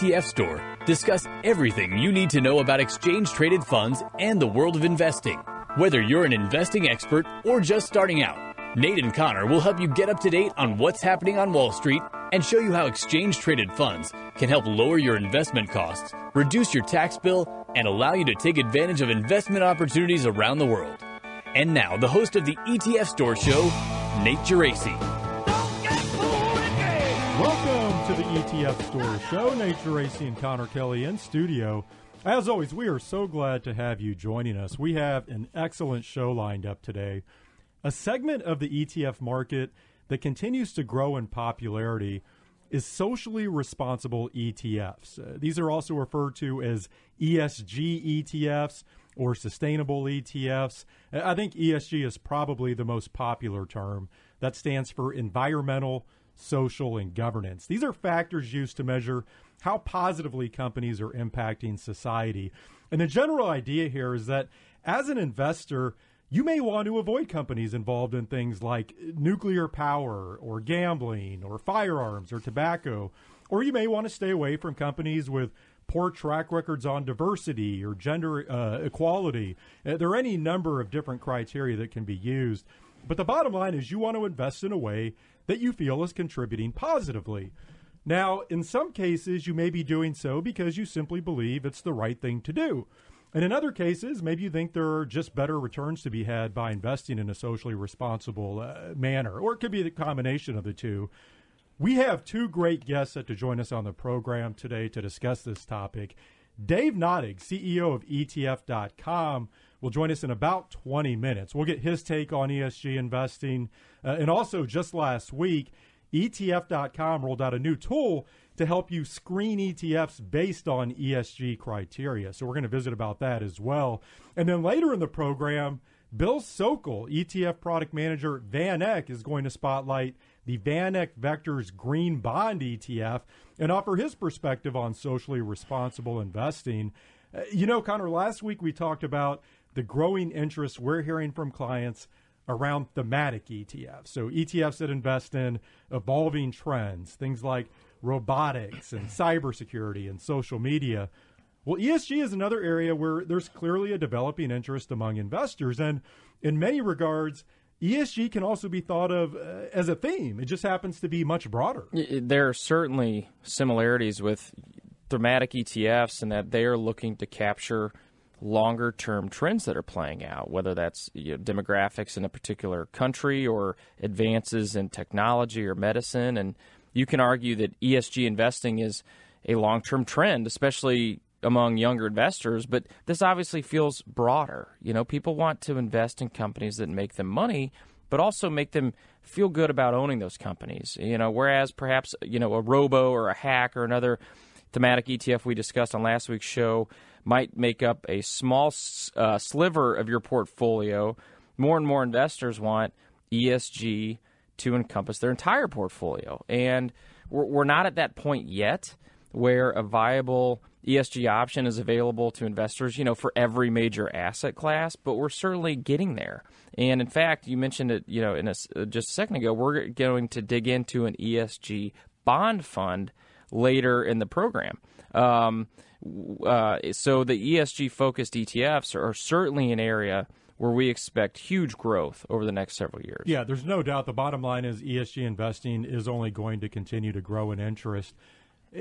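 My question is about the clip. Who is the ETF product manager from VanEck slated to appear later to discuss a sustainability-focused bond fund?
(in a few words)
Bill Sokol.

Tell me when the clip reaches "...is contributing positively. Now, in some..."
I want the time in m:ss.
1:26.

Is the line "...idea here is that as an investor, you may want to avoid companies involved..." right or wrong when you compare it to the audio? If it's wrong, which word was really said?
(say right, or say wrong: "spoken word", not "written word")
right.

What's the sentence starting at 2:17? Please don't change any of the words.
Uh, you know, Conor, last week we talked about the growing interest we're hearing from clients around thematic ETFs.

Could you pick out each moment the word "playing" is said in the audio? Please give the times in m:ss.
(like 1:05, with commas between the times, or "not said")
2:49.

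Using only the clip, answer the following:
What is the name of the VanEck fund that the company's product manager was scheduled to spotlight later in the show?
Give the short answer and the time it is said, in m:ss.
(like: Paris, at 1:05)
VanEck Vectors Green Bond ETF, at 2:10.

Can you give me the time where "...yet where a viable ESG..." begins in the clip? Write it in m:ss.
3:28.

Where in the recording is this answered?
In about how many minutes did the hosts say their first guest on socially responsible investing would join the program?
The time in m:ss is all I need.
1:50.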